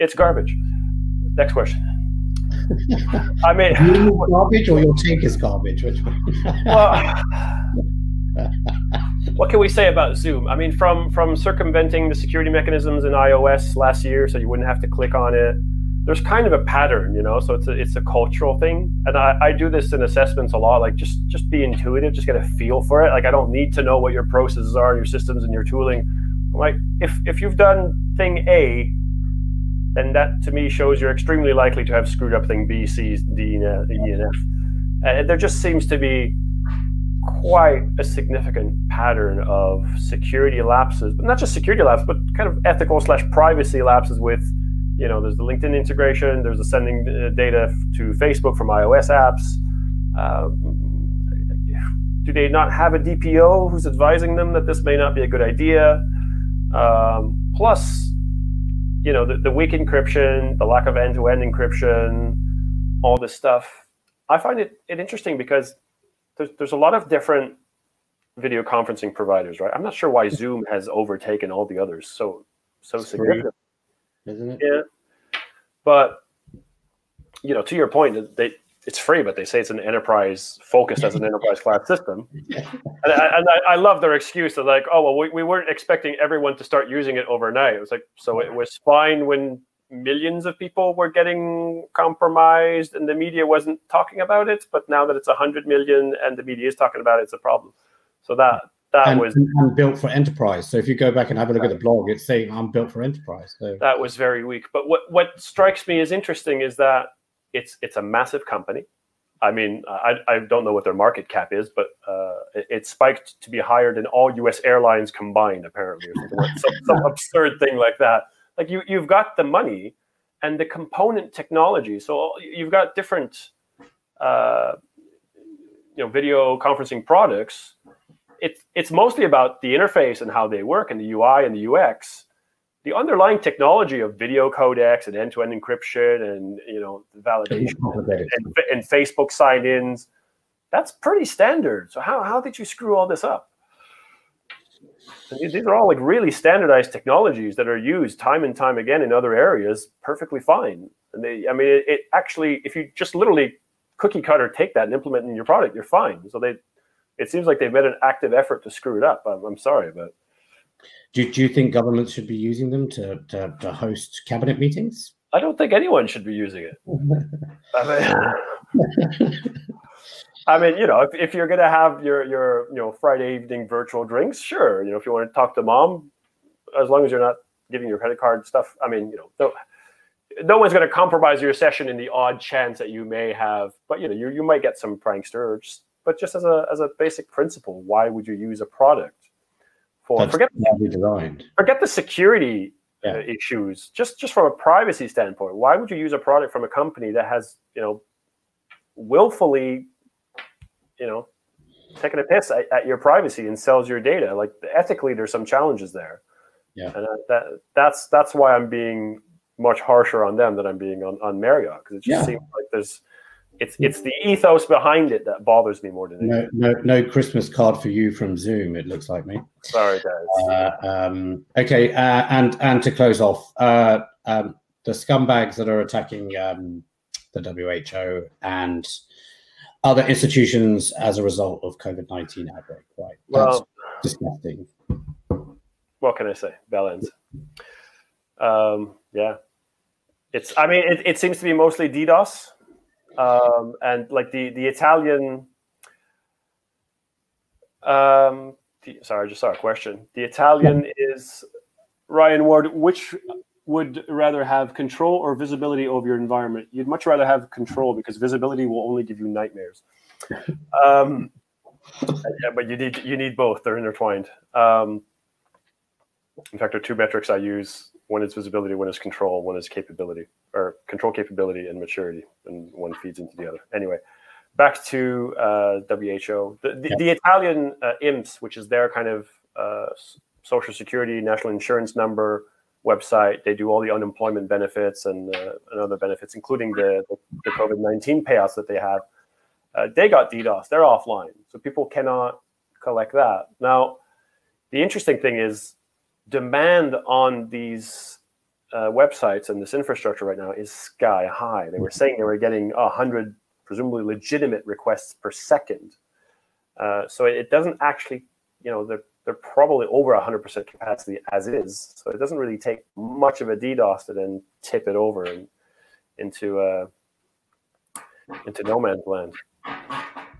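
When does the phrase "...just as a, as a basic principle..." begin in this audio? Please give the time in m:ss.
3:06.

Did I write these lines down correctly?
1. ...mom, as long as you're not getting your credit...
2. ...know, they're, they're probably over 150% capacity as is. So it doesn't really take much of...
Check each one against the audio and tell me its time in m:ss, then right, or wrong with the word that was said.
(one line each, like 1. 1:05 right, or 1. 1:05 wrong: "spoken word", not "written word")
1. 2:55 wrong: "giving", not "getting"
2. 5:08 wrong: "100", not "150".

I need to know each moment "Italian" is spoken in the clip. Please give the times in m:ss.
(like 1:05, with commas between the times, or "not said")
4:04, 4:10, 4:37.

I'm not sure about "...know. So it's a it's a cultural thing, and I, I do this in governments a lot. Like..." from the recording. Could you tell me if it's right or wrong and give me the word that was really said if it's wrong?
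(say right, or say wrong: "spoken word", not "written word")
wrong: "assessments", not "governments".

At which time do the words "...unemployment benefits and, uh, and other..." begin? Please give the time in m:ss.
4:43.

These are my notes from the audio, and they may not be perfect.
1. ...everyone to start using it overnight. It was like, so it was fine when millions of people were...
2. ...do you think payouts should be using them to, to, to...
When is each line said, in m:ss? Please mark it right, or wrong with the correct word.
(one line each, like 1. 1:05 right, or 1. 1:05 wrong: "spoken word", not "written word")
1. 1:26 right
2. 2:41 wrong: "governments", not "payouts".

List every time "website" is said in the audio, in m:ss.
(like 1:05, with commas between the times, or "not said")
4:42, 4:58.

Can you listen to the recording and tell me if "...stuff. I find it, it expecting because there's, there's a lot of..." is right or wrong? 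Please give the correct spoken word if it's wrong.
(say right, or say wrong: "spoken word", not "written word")
wrong: "interesting", not "expecting".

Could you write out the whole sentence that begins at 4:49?
Uh, they got DDoS, they're offline.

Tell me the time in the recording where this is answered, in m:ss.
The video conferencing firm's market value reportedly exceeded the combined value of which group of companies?
1:54.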